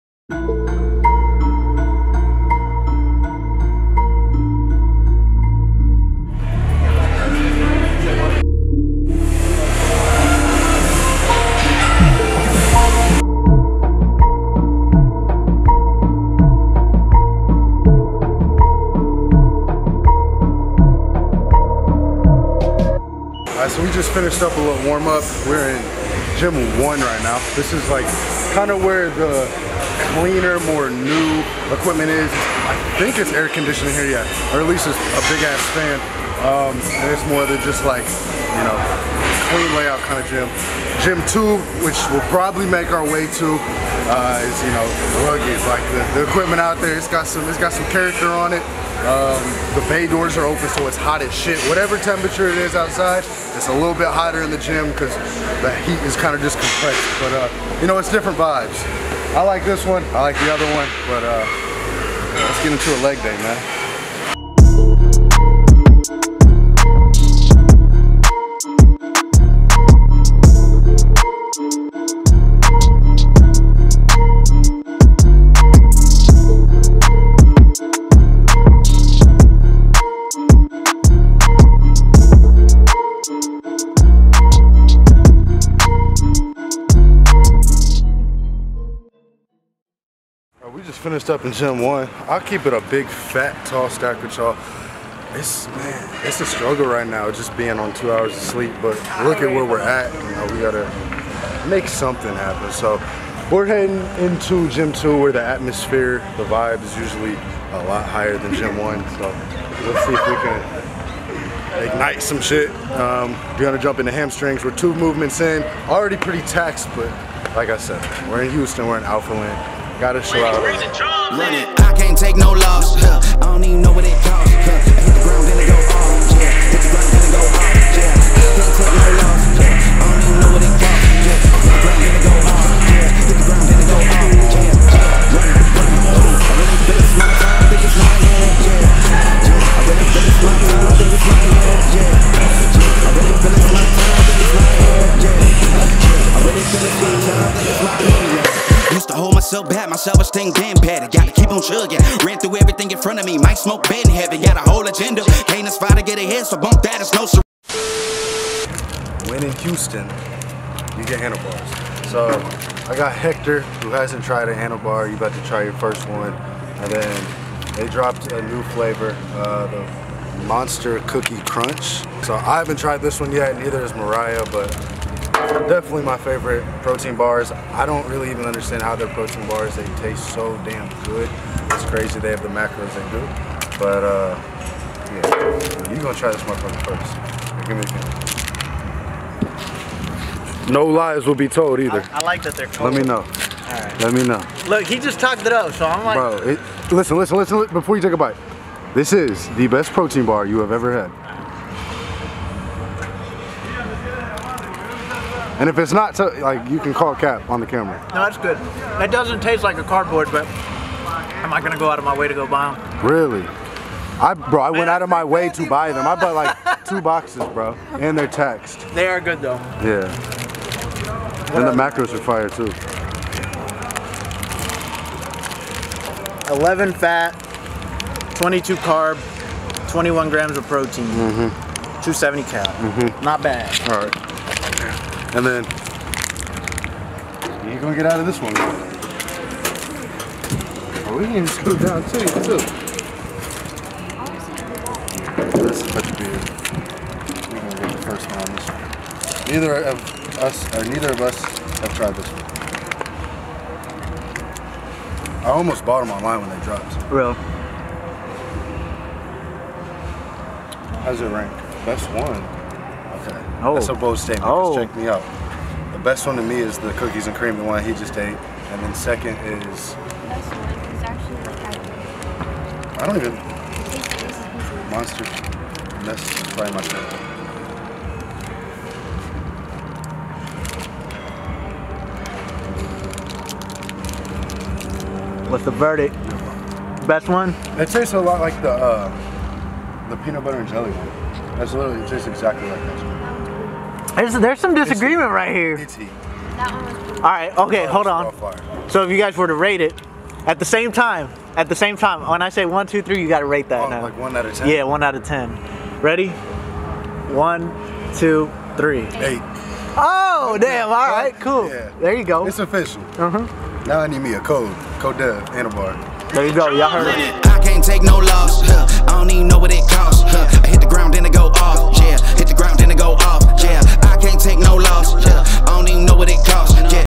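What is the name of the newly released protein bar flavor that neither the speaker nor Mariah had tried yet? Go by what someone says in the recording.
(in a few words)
Monster Cookie Crunch.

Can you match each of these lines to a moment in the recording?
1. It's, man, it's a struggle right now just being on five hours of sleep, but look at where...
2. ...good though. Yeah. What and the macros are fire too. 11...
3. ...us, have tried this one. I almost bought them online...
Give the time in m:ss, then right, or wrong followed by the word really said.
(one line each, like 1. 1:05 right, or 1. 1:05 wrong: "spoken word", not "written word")
1. 1:35 wrong: "two", not "five"
2. 3:39 right
3. 4:11 right.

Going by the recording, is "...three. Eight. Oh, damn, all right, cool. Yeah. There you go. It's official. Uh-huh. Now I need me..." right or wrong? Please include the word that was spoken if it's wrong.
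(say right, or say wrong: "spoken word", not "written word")
right.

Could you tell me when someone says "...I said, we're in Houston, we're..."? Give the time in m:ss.
1:57.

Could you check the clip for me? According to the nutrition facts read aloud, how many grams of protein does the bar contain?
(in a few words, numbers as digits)
21 grams.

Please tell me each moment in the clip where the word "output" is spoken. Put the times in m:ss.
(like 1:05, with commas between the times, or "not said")
not said.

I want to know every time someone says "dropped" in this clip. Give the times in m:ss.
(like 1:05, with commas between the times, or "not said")
2:47, 4:16.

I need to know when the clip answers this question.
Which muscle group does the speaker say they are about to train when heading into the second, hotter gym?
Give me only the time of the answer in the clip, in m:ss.
1:54.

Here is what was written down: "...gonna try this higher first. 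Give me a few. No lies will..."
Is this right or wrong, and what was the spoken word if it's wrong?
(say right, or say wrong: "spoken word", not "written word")
wrong: "motherfucker", not "higher".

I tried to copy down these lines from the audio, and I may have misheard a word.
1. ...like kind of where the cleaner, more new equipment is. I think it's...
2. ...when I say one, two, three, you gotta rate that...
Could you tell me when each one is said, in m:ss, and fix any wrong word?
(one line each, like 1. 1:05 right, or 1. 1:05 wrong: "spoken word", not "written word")
1. 0:27 right
2. 5:02 right.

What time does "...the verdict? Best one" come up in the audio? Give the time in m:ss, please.
4:45.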